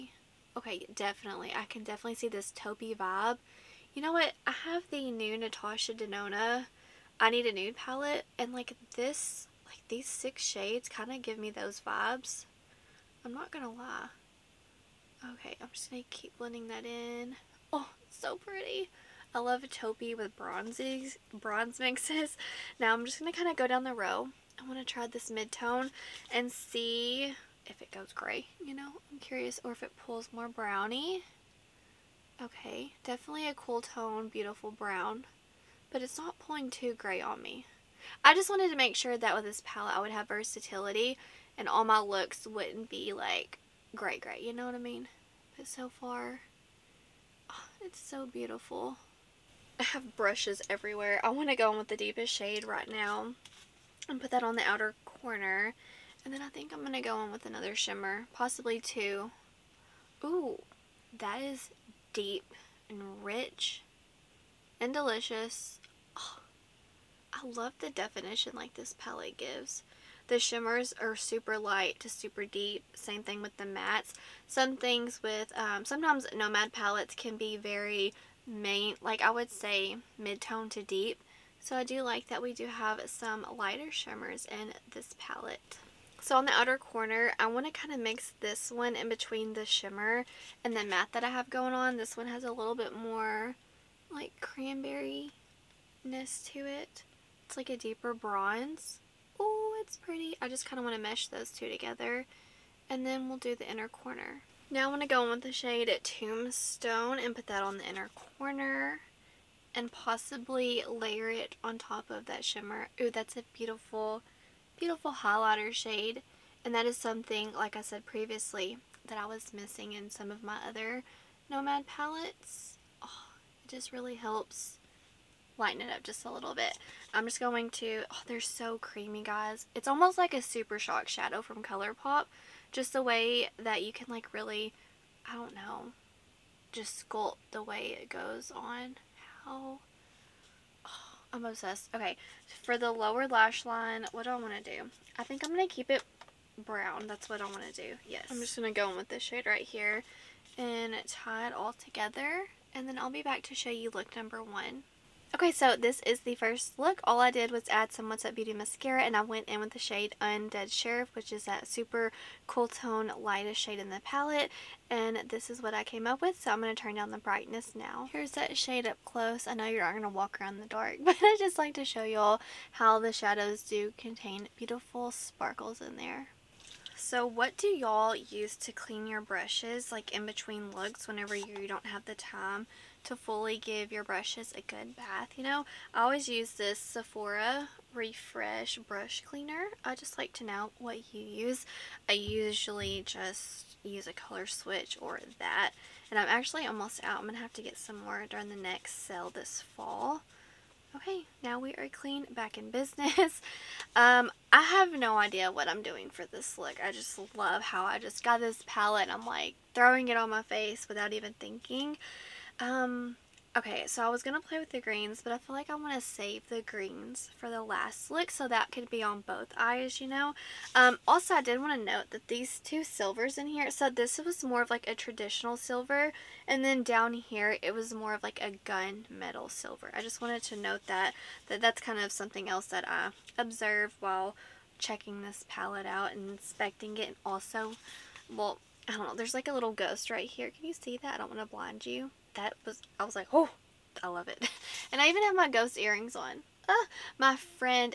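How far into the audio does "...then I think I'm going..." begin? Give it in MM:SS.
00:56.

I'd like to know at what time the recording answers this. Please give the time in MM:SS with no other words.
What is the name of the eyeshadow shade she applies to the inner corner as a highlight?
01:46.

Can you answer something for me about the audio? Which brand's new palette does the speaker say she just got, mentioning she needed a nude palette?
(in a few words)
Natasha Denona.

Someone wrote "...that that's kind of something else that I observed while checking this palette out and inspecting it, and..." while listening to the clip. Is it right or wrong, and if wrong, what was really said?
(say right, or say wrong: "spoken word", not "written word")
right.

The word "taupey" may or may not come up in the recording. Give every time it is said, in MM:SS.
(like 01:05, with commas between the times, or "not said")
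00:02, 00:19.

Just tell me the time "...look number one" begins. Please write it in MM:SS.
02:33.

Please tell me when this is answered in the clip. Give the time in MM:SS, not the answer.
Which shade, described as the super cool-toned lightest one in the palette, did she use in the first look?
02:40.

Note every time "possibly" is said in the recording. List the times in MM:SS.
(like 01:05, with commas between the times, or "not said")
00:58, 01:49.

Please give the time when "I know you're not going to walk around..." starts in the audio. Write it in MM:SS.
02:49.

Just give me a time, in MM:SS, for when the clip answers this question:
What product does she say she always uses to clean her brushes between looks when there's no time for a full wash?
03:06.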